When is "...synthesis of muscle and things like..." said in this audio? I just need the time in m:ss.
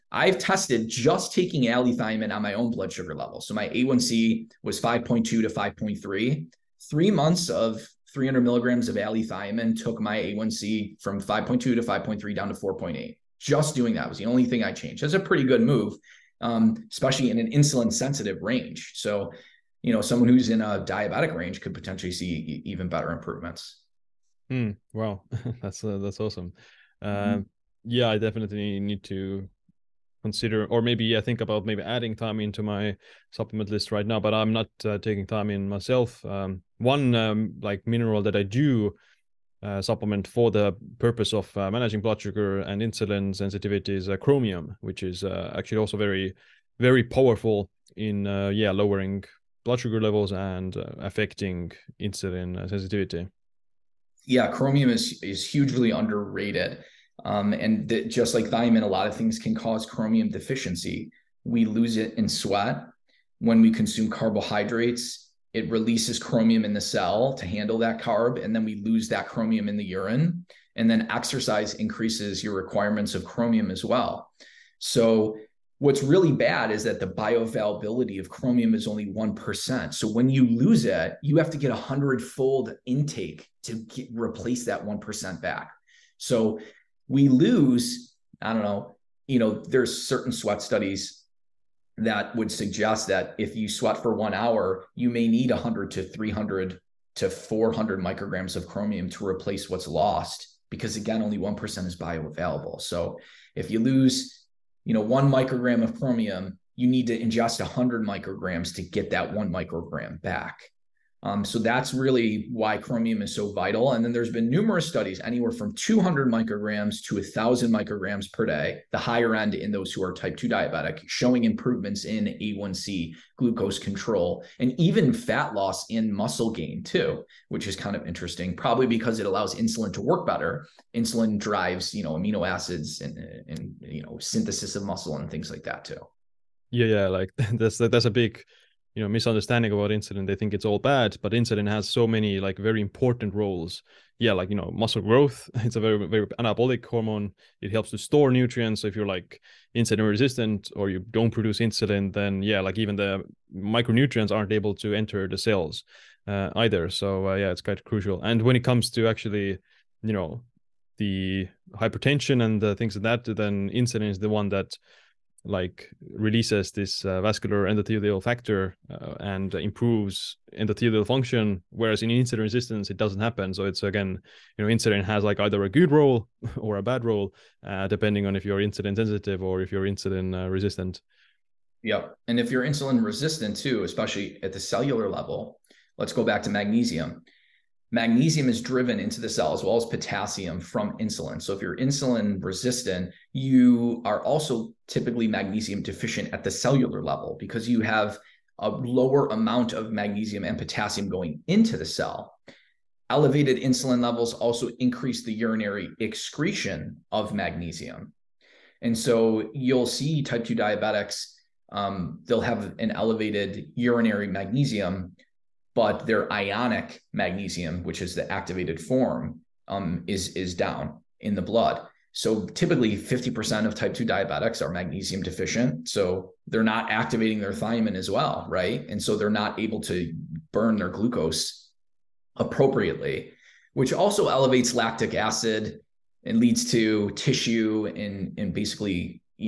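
2:14.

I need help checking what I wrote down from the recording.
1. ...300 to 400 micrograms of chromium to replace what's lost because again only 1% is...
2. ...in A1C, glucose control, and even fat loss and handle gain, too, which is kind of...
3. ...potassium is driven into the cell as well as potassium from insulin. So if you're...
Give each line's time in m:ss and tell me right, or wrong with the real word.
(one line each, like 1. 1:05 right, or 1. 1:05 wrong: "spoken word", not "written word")
1. 1:36 right
2. 2:02 wrong: "muscle", not "handle"
3. 3:07 wrong: "magnesium", not "potassium".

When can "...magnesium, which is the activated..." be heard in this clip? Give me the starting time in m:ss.
3:37.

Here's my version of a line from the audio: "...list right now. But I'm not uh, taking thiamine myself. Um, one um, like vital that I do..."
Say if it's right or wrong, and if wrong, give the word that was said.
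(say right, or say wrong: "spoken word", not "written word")
wrong: "mineral", not "vital".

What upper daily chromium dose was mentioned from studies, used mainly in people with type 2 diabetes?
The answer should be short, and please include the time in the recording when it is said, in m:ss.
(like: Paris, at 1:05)
1,000 micrograms, at 1:57.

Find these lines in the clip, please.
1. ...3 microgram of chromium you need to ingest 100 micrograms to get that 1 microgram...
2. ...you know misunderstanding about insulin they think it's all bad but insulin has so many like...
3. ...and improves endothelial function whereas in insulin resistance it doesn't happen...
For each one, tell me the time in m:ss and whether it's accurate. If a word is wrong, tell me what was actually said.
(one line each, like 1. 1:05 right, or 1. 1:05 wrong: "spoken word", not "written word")
1. 1:44 wrong: "1", not "3"
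2. 2:18 right
3. 2:49 right.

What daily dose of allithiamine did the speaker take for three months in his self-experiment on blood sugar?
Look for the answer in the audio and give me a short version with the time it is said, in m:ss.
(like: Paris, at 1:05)
300 milligrams, at 0:08.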